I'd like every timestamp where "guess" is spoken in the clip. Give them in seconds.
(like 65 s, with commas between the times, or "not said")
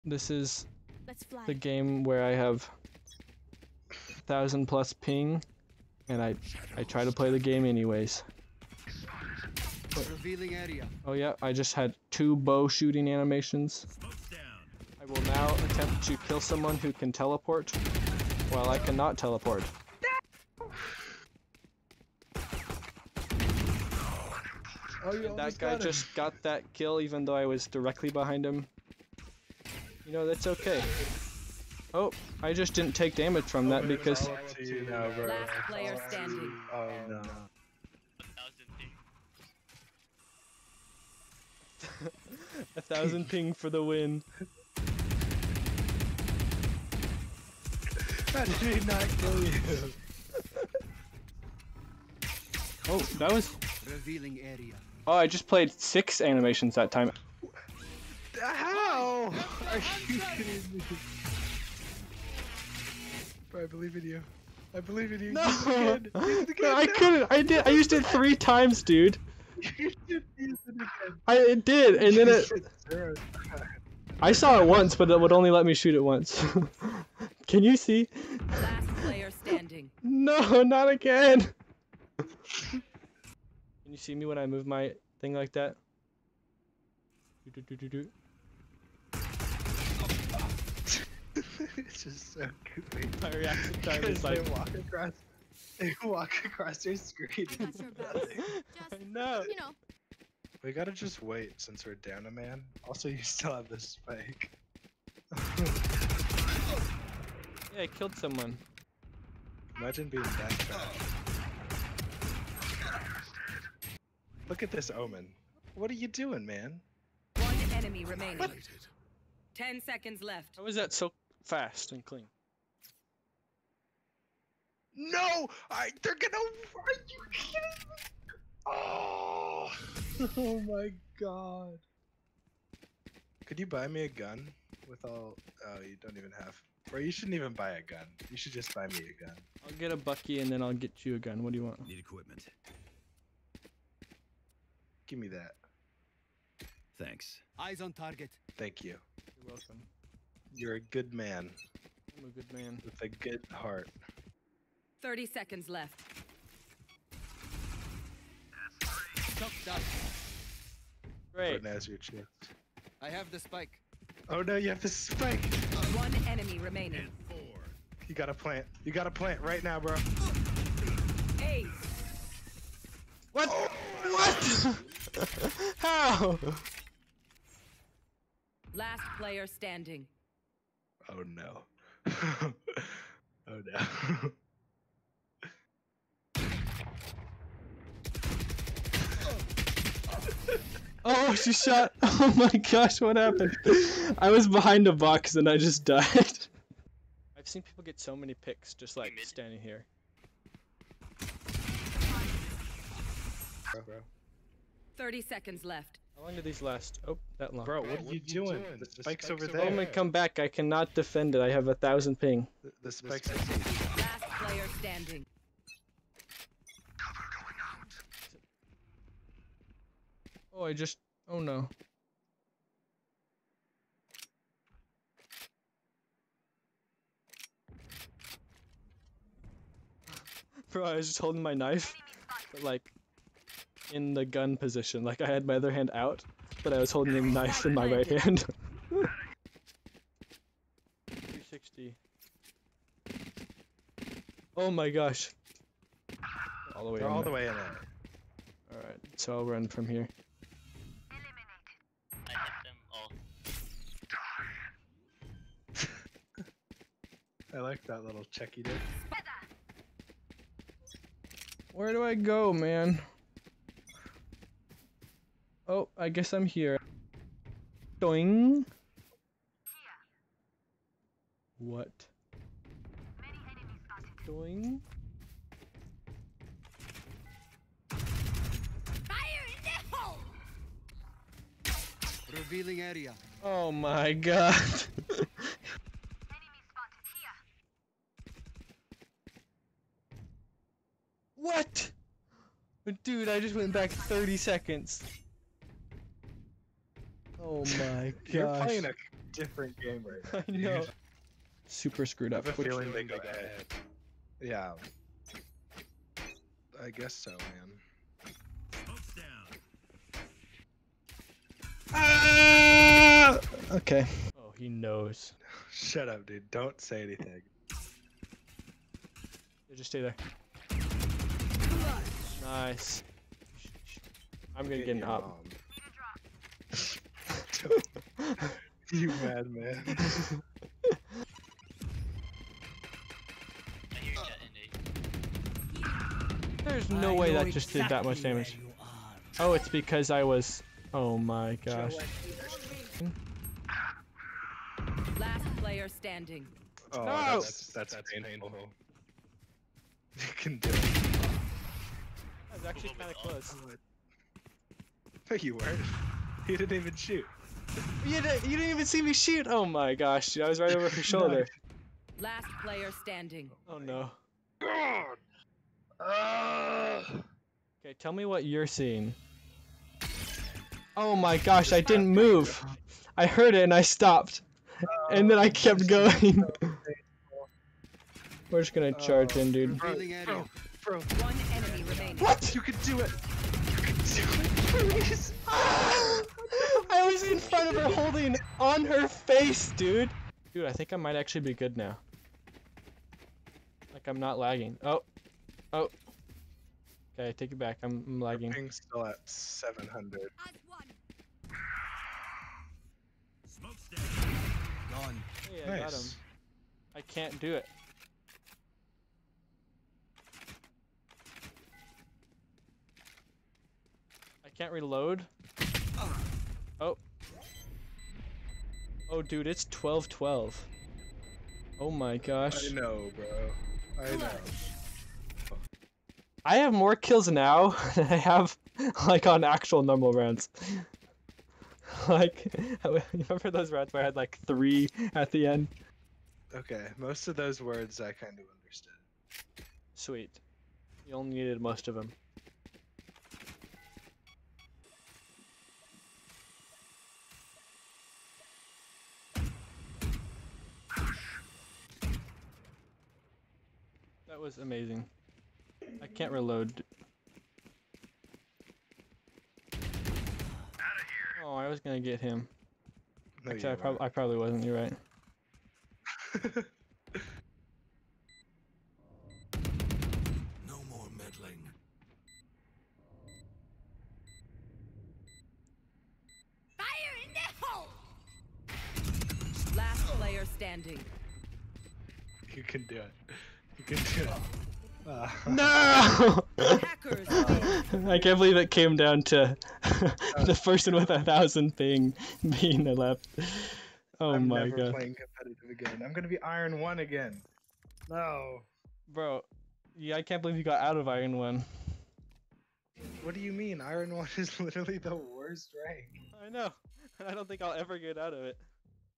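266 s, 306 s.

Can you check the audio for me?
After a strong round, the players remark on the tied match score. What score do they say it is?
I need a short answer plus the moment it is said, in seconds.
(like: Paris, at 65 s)
12-12, at 419 s.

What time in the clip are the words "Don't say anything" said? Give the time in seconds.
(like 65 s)
316 s.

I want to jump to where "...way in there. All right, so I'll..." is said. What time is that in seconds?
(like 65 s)
247 s.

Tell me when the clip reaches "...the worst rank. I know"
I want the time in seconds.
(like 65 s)
504 s.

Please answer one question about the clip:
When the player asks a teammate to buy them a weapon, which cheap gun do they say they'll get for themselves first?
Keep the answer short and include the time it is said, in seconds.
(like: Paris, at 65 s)
bucky, at 139 s.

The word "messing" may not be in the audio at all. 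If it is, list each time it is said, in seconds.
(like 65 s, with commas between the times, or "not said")
not said.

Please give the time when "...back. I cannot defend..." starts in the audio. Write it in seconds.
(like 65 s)
210 s.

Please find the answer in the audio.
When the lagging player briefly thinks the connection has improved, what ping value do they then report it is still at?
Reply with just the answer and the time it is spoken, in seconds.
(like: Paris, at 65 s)
700, at 399 s.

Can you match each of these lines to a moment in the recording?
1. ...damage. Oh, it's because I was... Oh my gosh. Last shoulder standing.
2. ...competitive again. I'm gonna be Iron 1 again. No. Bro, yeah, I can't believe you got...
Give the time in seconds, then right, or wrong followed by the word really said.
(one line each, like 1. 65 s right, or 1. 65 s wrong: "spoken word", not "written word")
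1. 338 s wrong: "player", not "shoulder"
2. 495 s right.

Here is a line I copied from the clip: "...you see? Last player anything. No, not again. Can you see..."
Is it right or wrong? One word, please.
wrong.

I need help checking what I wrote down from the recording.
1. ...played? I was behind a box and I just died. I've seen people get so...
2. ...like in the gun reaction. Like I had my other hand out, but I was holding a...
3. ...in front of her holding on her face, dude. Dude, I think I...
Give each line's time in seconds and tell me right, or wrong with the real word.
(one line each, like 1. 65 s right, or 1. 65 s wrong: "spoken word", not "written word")
1. 193 s wrong: "happened", not "played"
2. 232 s wrong: "position", not "reaction"
3. 387 s right.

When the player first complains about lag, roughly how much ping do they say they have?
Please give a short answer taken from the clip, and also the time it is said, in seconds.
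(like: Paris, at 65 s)
thousand plus, at 4 s.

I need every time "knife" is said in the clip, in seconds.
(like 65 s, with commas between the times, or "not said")
231 s, 237 s.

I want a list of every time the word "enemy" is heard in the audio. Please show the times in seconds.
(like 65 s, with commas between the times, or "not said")
117 s, 166 s, 381 s.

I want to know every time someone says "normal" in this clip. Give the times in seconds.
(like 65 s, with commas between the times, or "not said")
429 s.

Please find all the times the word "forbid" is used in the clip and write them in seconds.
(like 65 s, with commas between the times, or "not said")
not said.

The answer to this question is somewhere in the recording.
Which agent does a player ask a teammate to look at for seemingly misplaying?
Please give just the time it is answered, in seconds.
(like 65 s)
114 s.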